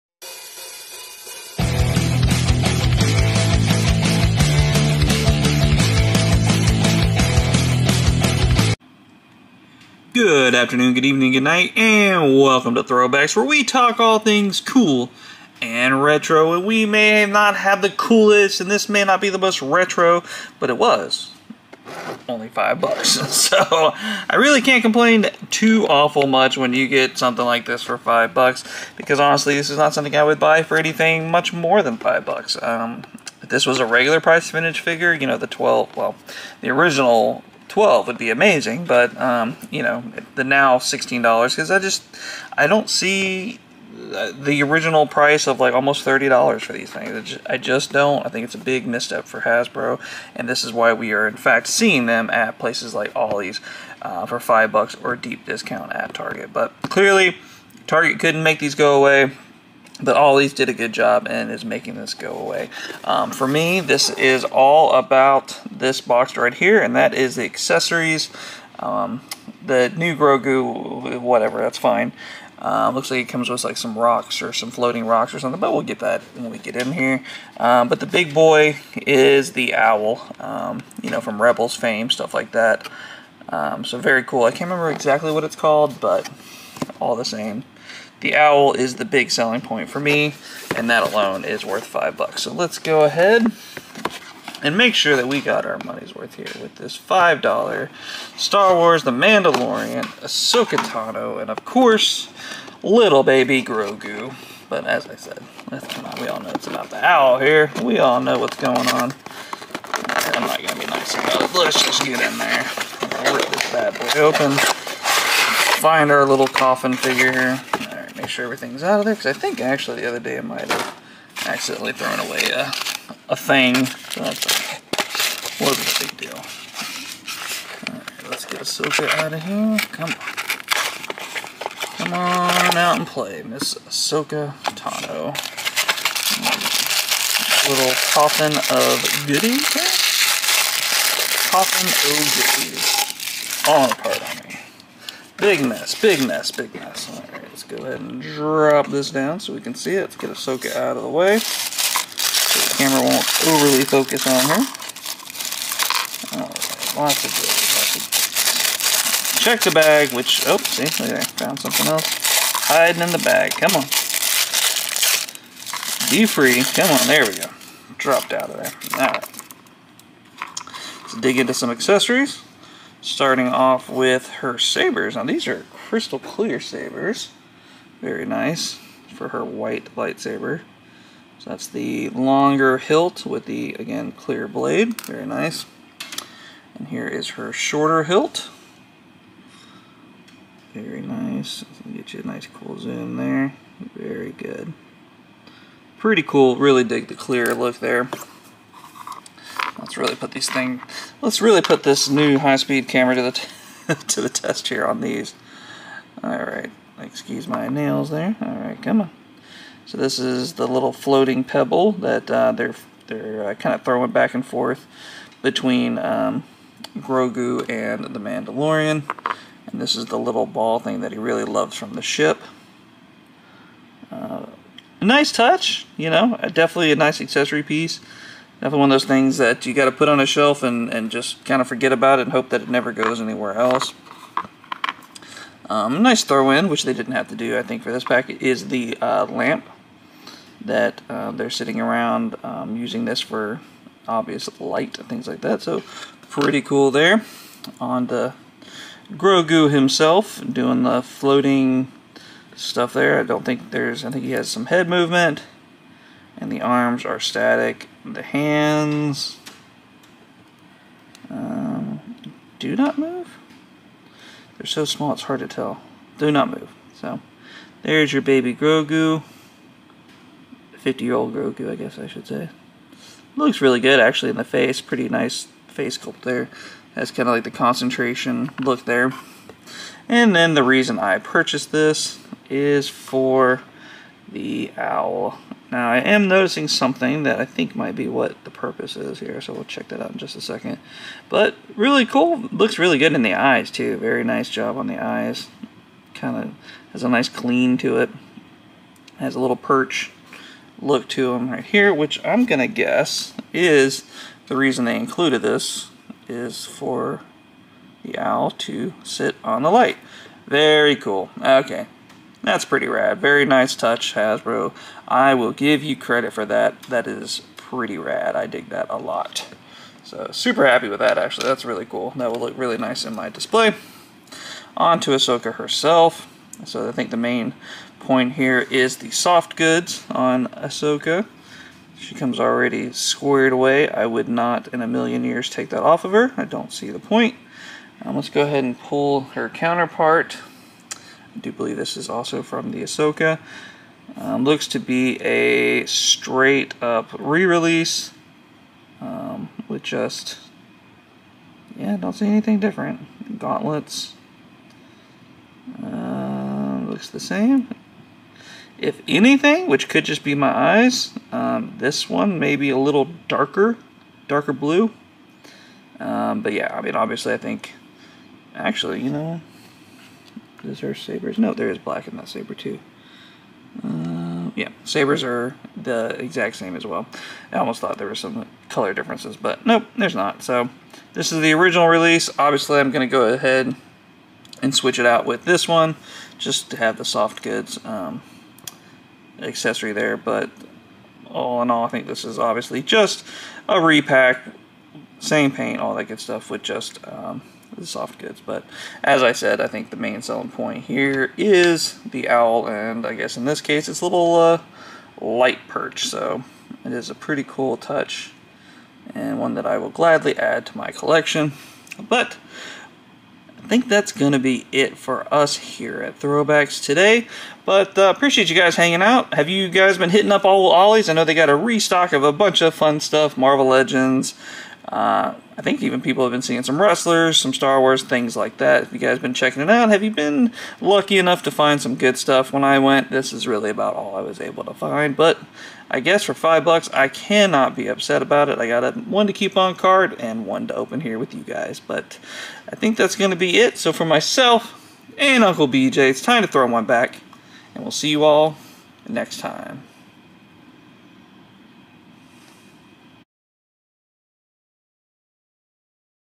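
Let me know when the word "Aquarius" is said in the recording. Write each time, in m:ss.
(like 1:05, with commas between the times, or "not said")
not said.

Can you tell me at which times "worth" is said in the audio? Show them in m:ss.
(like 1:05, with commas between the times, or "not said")
1:31, 1:36.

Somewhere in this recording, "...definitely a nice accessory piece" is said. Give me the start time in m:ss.
3:46.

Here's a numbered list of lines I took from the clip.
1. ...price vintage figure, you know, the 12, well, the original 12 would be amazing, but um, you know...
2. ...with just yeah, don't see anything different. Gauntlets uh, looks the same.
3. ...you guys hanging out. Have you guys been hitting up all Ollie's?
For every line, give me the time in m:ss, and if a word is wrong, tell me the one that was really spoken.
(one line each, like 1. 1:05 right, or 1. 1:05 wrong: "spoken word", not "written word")
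1. 0:34 right
2. 5:49 right
3. 6:58 right.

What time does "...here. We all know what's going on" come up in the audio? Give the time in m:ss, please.
1:47.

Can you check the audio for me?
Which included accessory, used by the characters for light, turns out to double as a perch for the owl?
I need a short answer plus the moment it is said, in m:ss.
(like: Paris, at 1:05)
lamp, at 3:59.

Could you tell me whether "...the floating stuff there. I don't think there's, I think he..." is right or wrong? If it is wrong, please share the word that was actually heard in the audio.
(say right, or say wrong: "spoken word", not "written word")
right.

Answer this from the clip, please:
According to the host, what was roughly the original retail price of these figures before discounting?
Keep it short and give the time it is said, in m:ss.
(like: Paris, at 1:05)
almost $30, at 0:45.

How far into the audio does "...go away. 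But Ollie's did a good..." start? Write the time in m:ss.
0:58.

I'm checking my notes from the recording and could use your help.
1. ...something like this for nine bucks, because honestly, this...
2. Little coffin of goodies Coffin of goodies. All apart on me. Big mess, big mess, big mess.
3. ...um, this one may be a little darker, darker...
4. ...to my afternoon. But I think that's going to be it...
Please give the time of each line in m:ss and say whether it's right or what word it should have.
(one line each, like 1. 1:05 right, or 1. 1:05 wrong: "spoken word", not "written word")
1. 0:27 wrong: "five", not "nine"
2. 2:17 right
3. 6:01 right
4. 6:50 wrong: "collection", not "afternoon".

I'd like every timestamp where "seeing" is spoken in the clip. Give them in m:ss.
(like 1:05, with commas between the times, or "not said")
0:51, 7:06.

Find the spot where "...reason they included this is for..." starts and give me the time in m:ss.
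5:04.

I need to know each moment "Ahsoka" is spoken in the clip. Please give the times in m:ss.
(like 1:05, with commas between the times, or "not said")
1:40, 2:08, 2:13, 2:30, 5:25, 5:30, 5:42.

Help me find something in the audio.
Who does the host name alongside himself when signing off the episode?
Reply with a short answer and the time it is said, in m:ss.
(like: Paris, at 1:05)
Uncle BJ, at 7:25.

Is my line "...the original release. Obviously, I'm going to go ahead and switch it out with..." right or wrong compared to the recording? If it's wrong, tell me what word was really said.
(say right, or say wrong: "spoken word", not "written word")
right.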